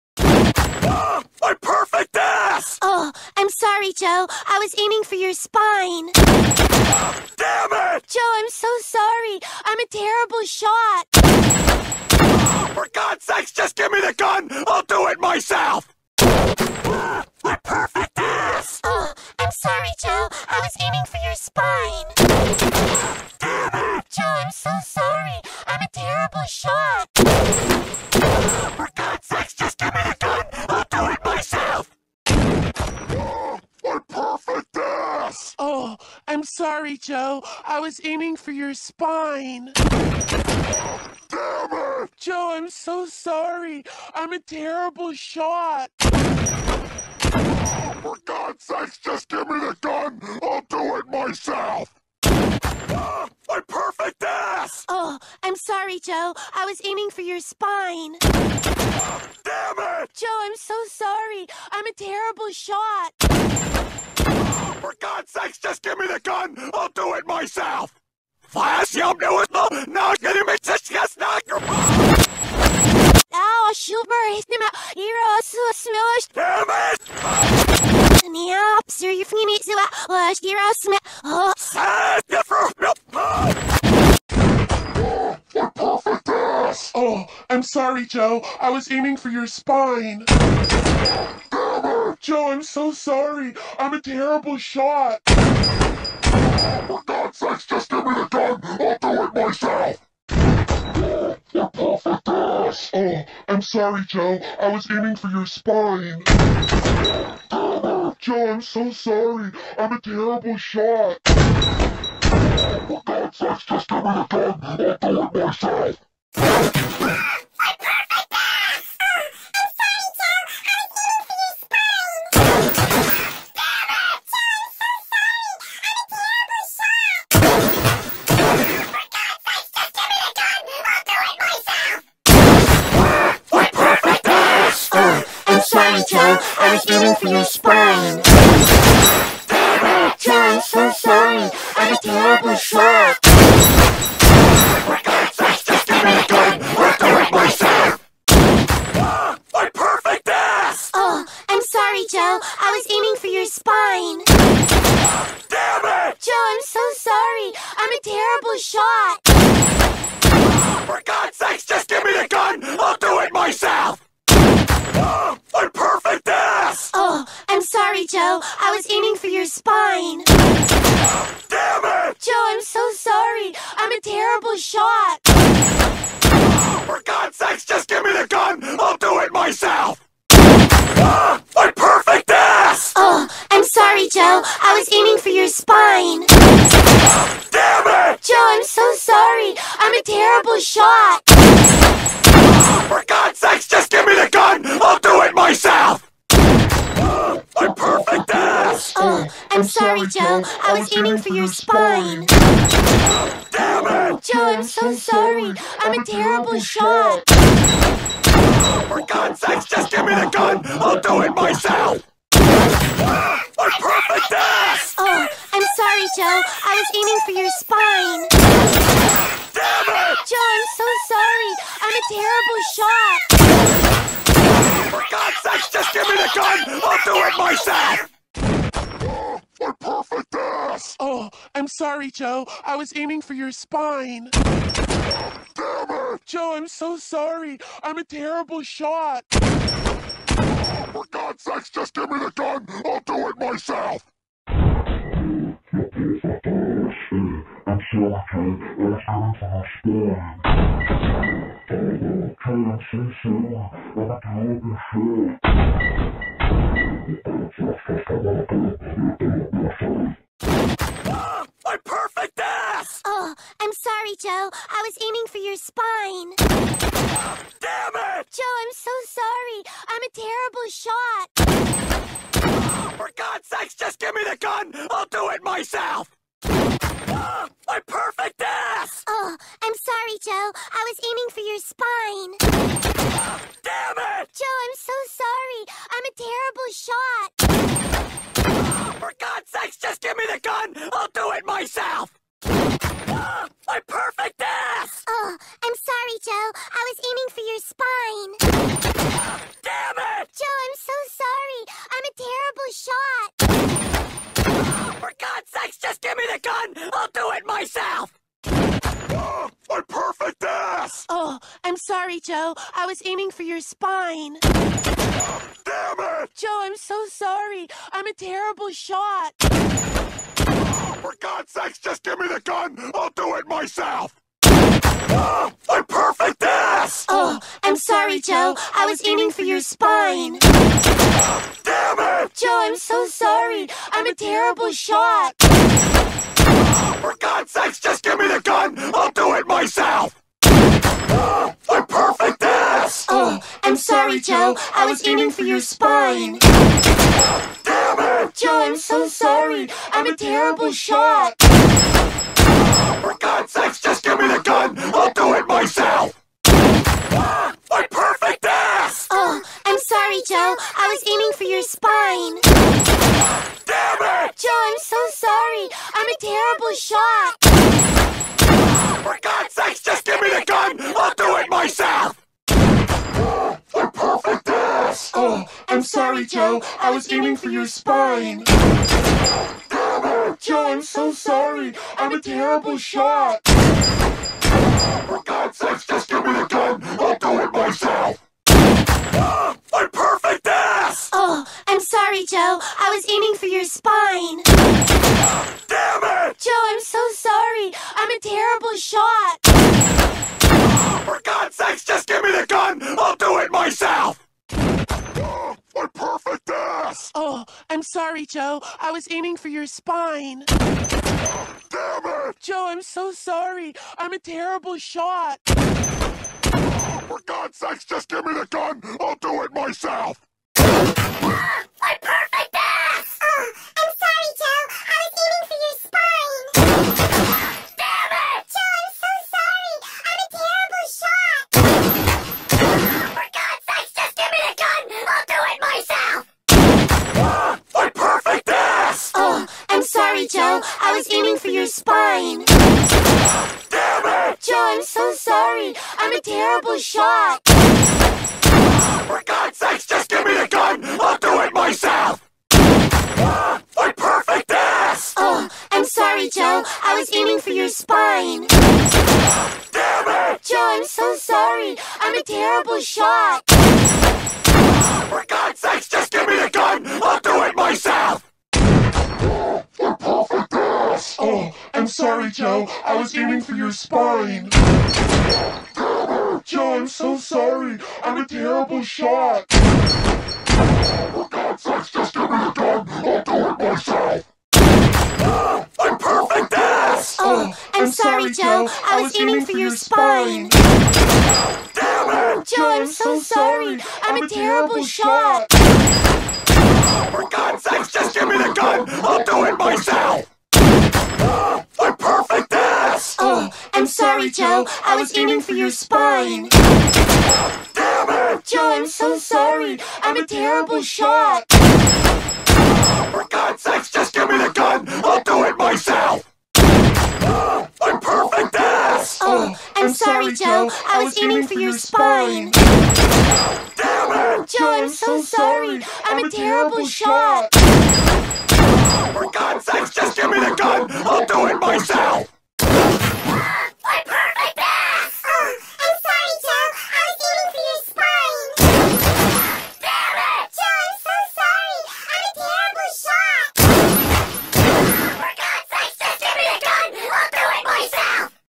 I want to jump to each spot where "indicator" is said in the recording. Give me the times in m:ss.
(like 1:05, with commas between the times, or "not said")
not said.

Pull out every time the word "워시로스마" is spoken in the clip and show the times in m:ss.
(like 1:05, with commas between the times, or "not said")
1:20.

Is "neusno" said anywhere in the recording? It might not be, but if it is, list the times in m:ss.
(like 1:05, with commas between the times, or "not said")
1:09.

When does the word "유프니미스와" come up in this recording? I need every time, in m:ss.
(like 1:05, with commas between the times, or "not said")
1:19.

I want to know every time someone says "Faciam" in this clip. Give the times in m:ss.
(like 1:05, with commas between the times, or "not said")
1:08.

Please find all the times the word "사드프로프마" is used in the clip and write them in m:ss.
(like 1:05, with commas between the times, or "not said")
1:21.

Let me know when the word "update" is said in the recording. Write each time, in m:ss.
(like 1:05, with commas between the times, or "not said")
not said.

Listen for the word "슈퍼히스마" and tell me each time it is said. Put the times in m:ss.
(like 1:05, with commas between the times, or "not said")
1:13.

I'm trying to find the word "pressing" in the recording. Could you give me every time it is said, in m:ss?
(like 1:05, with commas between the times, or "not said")
not said.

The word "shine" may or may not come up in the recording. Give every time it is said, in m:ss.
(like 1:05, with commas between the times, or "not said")
not said.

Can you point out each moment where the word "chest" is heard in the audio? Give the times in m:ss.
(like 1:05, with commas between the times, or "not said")
5:10.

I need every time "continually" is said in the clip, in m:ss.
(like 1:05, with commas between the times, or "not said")
not said.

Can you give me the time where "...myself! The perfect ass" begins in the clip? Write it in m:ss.
6:11.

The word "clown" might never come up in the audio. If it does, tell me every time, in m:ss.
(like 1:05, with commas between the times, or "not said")
not said.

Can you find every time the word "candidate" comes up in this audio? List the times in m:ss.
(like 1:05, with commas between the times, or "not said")
not said.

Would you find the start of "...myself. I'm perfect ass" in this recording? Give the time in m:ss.
8:35.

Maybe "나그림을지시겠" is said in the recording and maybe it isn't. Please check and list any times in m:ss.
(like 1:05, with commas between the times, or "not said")
1:09.